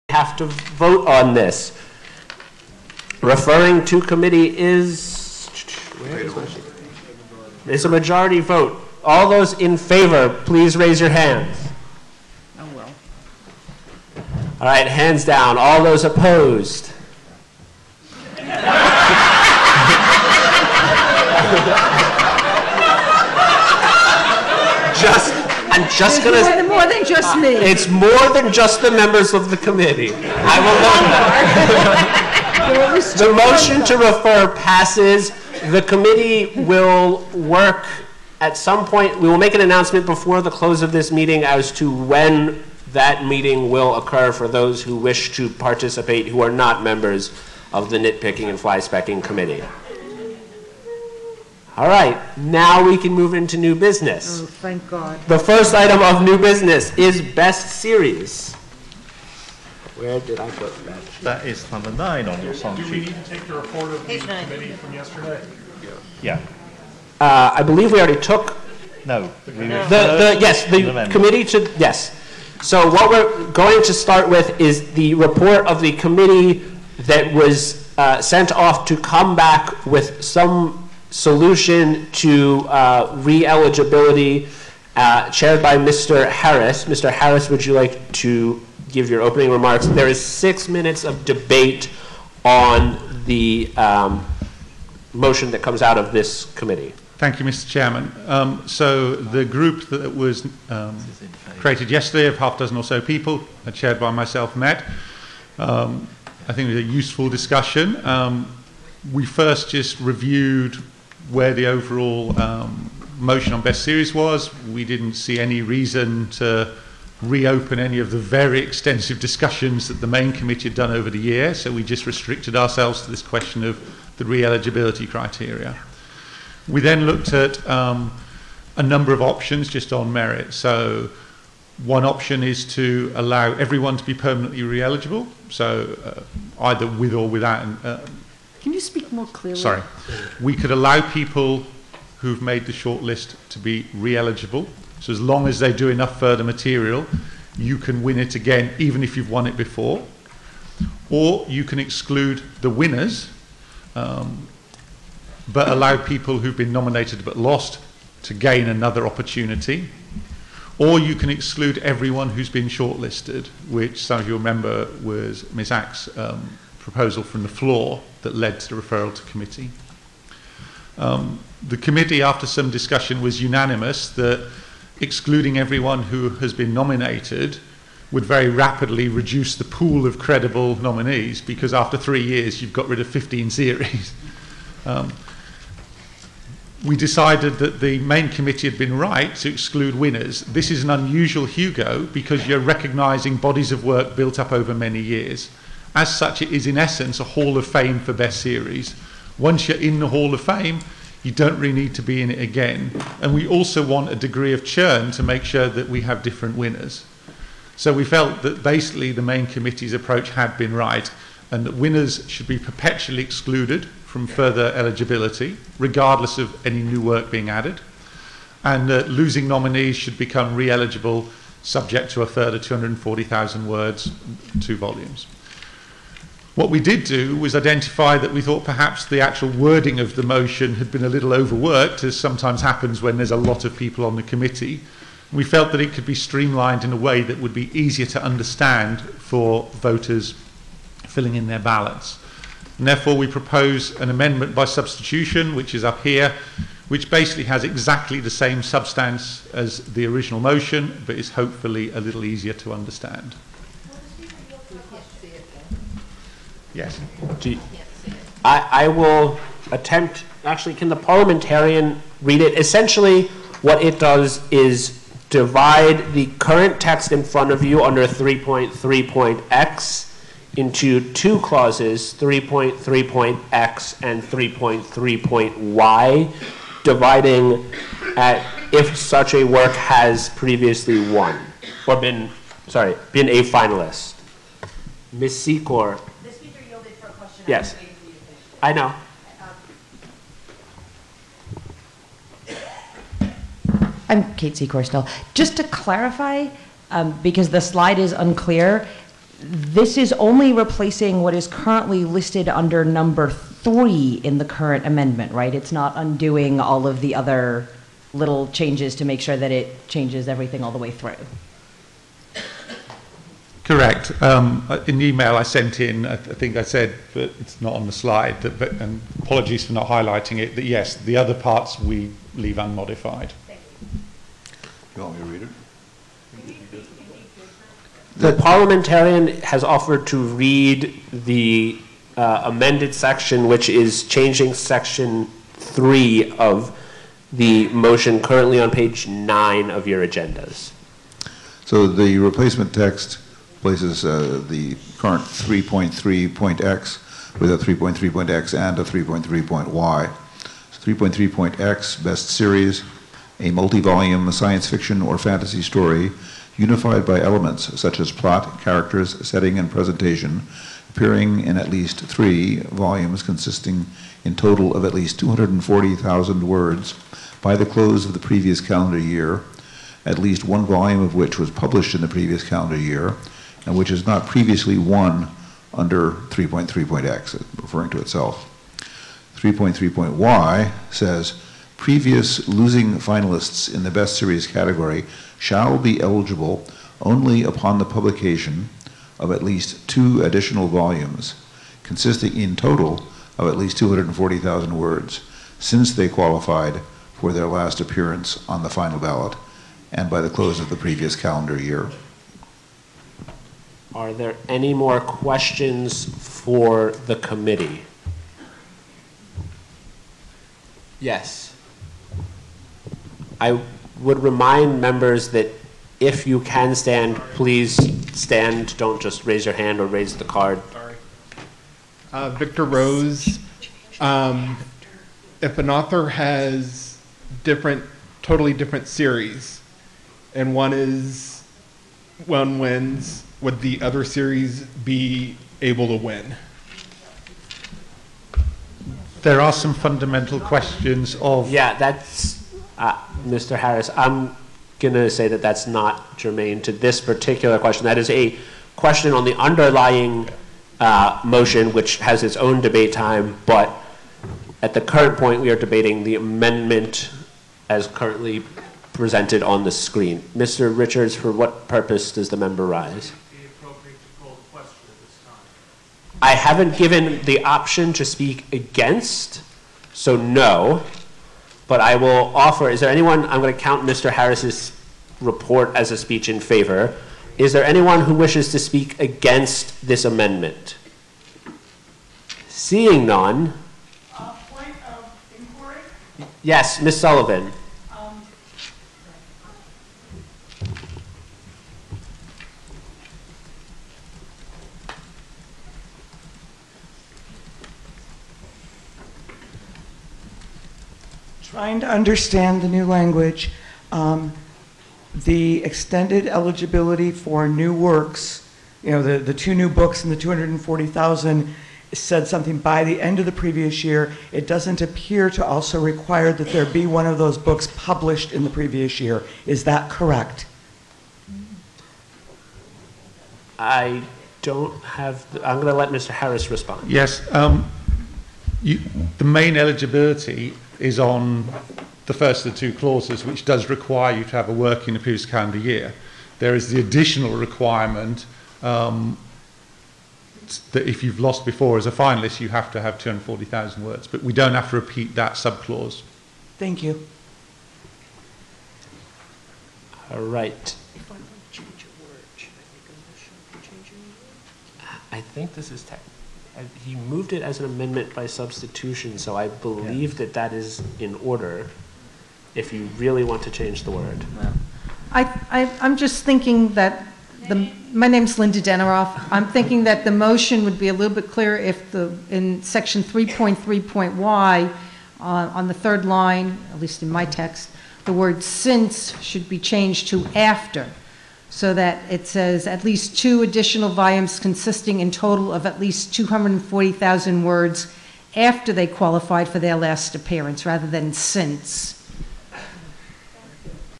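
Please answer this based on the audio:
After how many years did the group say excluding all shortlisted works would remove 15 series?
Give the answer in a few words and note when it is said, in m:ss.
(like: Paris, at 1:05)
3, at 3:01.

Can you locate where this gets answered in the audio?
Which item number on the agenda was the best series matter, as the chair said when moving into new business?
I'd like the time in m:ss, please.
1:01.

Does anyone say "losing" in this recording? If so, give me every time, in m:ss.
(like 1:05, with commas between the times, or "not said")
3:39, 6:22.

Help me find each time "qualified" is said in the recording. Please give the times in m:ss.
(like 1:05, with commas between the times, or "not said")
6:36, 9:48.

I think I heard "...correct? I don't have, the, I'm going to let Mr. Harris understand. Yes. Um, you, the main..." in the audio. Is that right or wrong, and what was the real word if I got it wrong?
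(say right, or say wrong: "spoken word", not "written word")
wrong: "respond", not "understand".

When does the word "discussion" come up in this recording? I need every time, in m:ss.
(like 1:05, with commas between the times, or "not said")
1:47, 1:59, 2:52.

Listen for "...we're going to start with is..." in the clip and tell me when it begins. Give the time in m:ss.
1:13.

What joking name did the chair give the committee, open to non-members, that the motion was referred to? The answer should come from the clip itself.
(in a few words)
nitpicking and fly specking committee.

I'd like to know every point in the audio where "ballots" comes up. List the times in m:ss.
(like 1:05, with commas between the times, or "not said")
4:01, 6:38.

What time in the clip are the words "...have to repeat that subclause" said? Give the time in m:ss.
9:04.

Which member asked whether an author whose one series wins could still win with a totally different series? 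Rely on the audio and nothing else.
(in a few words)
Victor Rose.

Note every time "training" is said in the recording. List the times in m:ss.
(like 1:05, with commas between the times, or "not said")
not said.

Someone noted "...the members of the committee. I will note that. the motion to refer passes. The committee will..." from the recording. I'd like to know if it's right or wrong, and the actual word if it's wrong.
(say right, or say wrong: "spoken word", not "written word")
right.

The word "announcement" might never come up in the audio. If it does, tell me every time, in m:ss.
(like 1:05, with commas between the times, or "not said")
0:39.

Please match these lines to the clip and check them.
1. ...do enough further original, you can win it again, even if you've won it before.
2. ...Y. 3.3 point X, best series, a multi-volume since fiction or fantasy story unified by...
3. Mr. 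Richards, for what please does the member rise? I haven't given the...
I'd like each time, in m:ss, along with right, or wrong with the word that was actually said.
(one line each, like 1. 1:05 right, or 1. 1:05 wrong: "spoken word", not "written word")
1. 2:25 wrong: "material", not "original"
2. 5:49 wrong: "science", not "since"
3. 7:40 wrong: "purpose", not "please".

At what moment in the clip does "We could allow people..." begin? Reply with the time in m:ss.
2:20.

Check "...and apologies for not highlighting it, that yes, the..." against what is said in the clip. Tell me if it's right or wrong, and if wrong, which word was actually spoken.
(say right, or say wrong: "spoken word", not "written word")
right.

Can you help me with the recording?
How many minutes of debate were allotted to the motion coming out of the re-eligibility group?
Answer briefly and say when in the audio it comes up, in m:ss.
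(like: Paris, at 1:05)
6, at 1:30.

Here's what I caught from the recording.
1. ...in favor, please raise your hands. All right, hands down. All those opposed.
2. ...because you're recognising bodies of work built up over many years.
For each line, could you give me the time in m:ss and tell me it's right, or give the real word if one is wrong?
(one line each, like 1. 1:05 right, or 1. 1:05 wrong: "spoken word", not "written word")
1. 0:09 right
2. 3:12 right.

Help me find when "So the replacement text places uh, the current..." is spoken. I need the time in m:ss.
5:41.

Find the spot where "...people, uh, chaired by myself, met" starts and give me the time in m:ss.
1:42.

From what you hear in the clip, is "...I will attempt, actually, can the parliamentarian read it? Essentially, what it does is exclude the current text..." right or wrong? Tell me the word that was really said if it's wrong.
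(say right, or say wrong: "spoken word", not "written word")
wrong: "divide", not "exclude".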